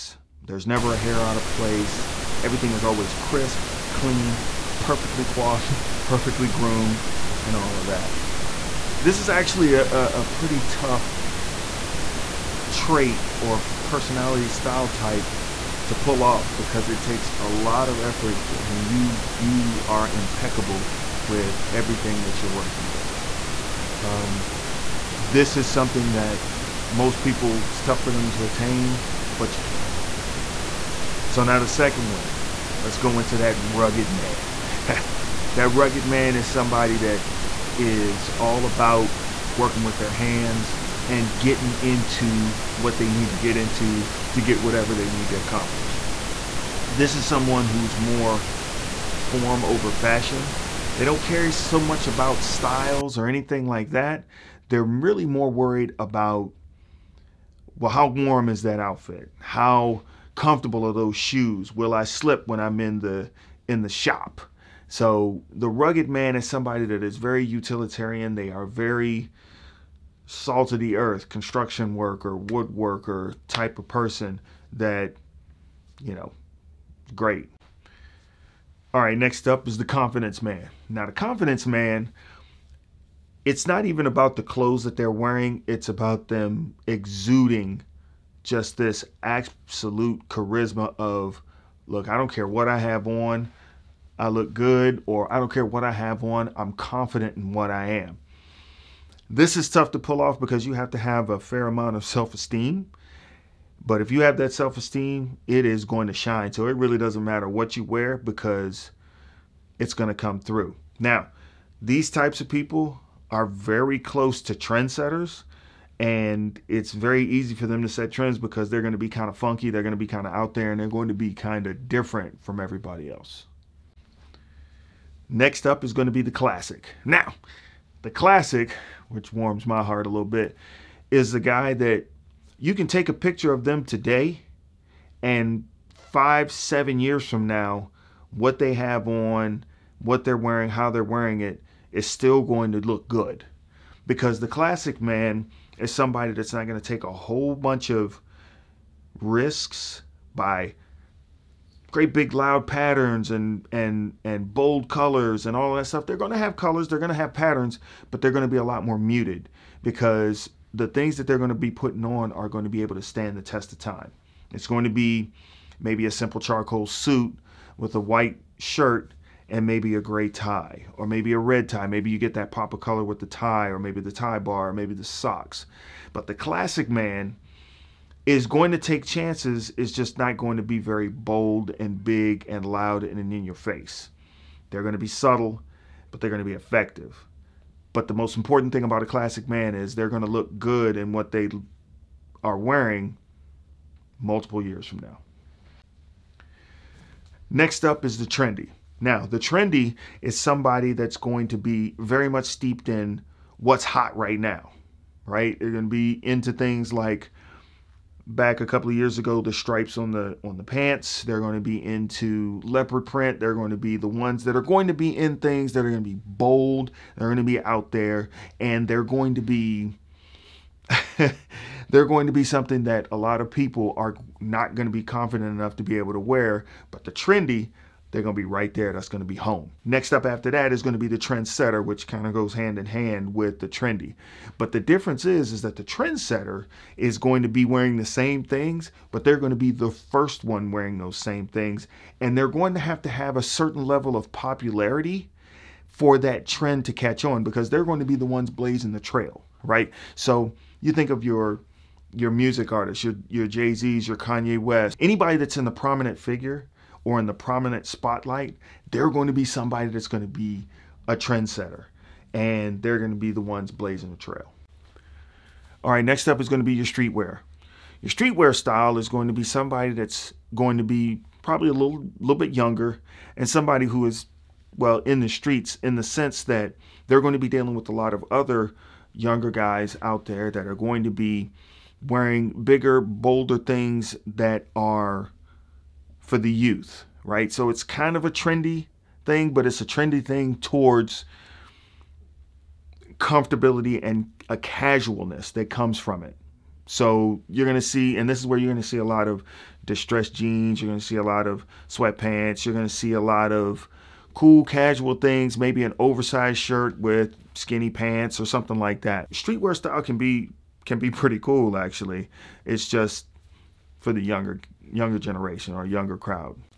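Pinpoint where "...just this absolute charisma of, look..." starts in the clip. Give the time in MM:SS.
01:28.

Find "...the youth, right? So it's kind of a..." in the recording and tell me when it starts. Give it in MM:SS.
04:46.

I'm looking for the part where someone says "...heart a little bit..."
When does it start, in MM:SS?
02:09.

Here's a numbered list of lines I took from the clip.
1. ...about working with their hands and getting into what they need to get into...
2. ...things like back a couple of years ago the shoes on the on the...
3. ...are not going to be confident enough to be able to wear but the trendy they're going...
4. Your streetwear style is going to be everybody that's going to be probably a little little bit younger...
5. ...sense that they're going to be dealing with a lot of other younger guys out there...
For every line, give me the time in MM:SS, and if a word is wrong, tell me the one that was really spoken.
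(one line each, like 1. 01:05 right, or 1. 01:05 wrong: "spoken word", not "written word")
1. 00:38 right
2. 03:26 wrong: "stripes", not "shoes"
3. 03:43 right
4. 04:28 wrong: "somebody", not "everybody"
5. 04:36 right.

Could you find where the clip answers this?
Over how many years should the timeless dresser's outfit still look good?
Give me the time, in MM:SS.
02:16.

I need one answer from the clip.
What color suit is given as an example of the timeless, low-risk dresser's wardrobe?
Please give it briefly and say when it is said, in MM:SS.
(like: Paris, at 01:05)
charcoal, at 02:46.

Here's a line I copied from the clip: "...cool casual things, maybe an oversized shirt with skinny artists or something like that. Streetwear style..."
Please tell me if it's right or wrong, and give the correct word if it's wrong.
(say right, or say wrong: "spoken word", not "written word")
wrong: "pants", not "artists".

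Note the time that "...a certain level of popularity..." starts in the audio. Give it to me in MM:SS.
04:03.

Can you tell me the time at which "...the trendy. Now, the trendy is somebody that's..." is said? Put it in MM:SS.
03:18.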